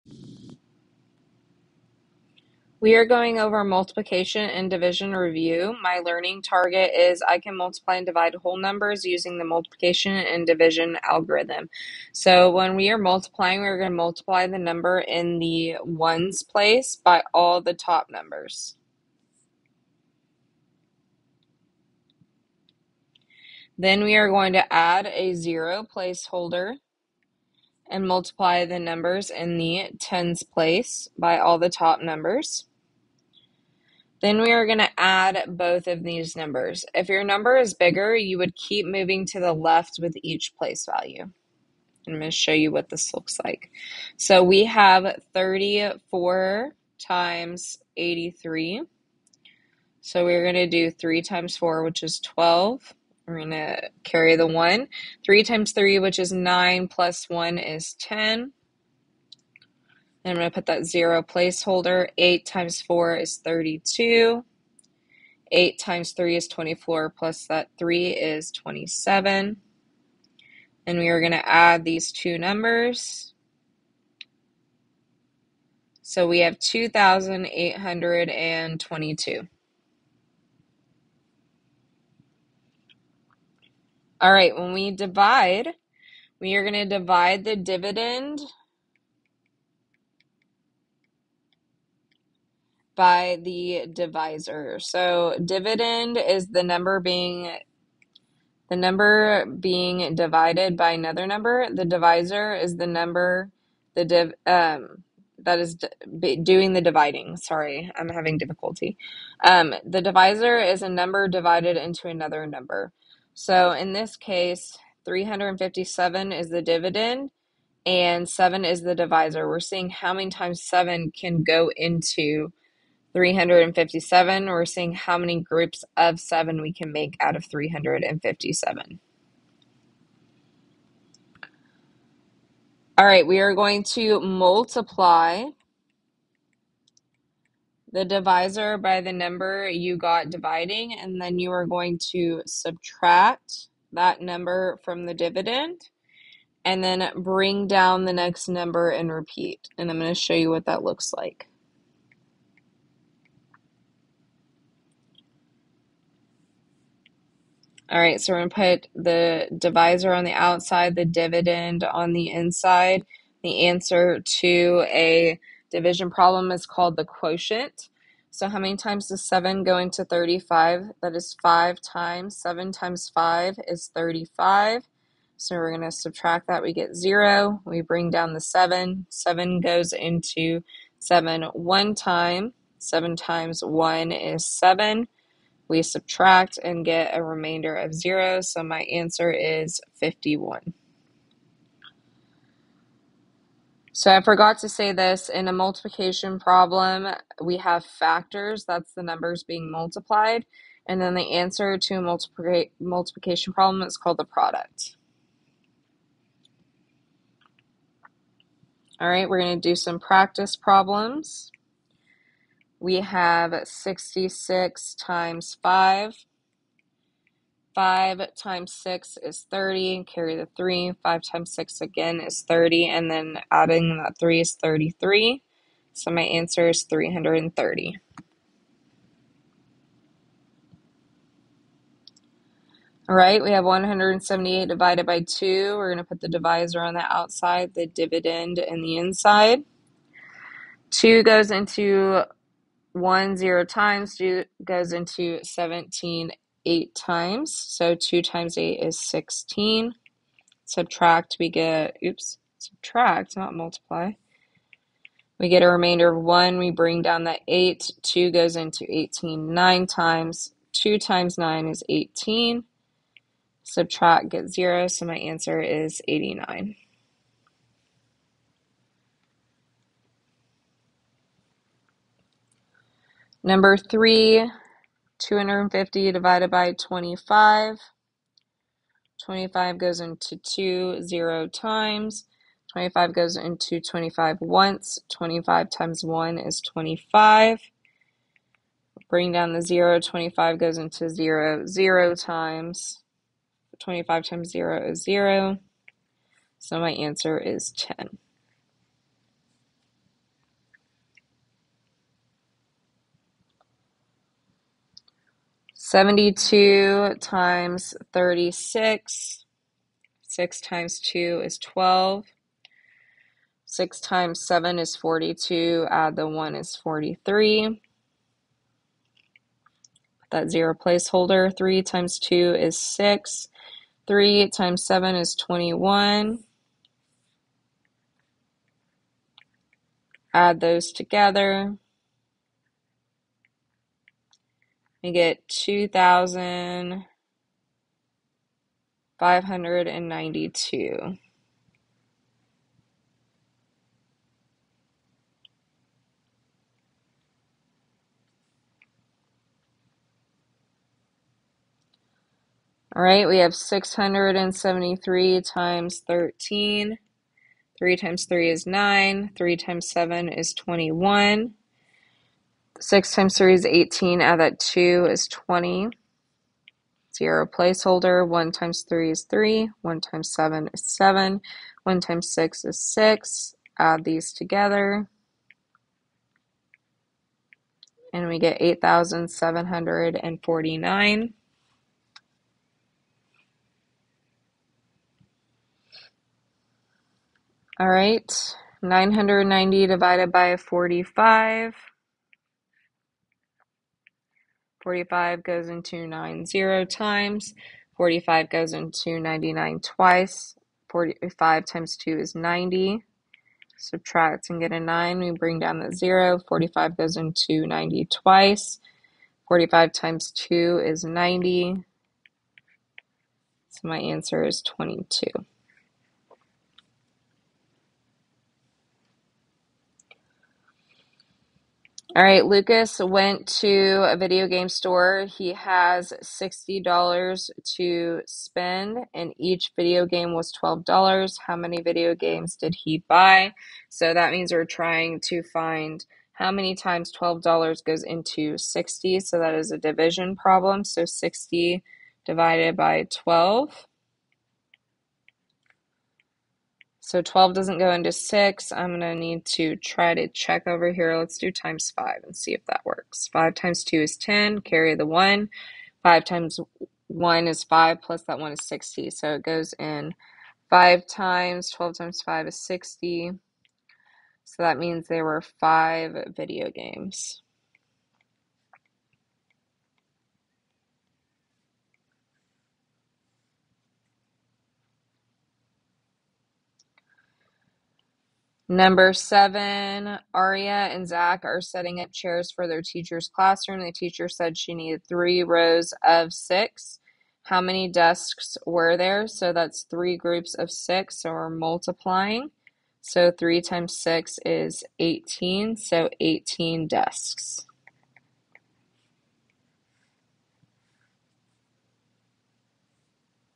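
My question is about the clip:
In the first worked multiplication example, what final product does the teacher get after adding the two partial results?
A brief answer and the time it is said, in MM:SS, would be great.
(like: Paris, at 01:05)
2,822, at 01:16.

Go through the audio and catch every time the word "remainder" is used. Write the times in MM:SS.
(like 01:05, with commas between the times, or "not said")
03:07, 04:15.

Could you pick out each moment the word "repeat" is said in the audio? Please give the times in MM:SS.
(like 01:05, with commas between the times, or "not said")
02:29.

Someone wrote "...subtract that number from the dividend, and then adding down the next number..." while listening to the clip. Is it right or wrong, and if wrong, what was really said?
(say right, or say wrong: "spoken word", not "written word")
wrong: "bring", not "adding".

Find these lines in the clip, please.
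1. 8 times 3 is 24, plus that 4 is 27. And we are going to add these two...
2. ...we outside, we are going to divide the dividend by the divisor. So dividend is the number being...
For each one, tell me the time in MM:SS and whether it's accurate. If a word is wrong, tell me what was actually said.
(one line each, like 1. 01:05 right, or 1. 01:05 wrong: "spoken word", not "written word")
1. 01:05 wrong: "3", not "4"
2. 01:24 wrong: "divide", not "outside".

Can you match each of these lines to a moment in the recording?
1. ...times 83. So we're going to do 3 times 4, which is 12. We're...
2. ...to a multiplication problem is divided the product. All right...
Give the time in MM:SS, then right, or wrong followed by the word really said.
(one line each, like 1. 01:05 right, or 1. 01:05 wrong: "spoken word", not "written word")
1. 00:46 right
2. 03:21 wrong: "called", not "divided".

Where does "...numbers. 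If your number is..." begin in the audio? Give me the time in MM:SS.
00:36.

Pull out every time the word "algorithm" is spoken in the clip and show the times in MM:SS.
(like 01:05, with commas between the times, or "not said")
00:11.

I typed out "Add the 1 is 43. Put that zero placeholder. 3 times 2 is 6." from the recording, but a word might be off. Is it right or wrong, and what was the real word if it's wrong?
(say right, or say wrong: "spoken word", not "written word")
right.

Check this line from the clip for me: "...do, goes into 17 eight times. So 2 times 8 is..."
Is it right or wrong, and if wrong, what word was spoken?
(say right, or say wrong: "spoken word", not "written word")
right.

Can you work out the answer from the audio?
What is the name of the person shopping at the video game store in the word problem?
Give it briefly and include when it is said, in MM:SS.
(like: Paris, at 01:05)
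Lucas, at 07:02.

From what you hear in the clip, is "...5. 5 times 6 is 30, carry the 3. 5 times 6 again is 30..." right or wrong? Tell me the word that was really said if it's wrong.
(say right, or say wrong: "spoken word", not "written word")
right.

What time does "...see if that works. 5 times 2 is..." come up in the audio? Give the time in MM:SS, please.
07:32.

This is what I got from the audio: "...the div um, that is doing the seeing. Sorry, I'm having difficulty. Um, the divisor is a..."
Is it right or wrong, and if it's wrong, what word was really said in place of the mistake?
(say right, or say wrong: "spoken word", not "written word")
wrong: "dividing", not "seeing".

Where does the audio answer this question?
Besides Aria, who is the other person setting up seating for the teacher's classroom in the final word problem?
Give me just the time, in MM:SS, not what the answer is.
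08:01.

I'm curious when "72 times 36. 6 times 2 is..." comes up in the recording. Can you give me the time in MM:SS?
05:05.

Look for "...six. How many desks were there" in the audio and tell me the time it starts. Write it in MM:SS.
08:06.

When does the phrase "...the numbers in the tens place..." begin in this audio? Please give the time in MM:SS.
00:28.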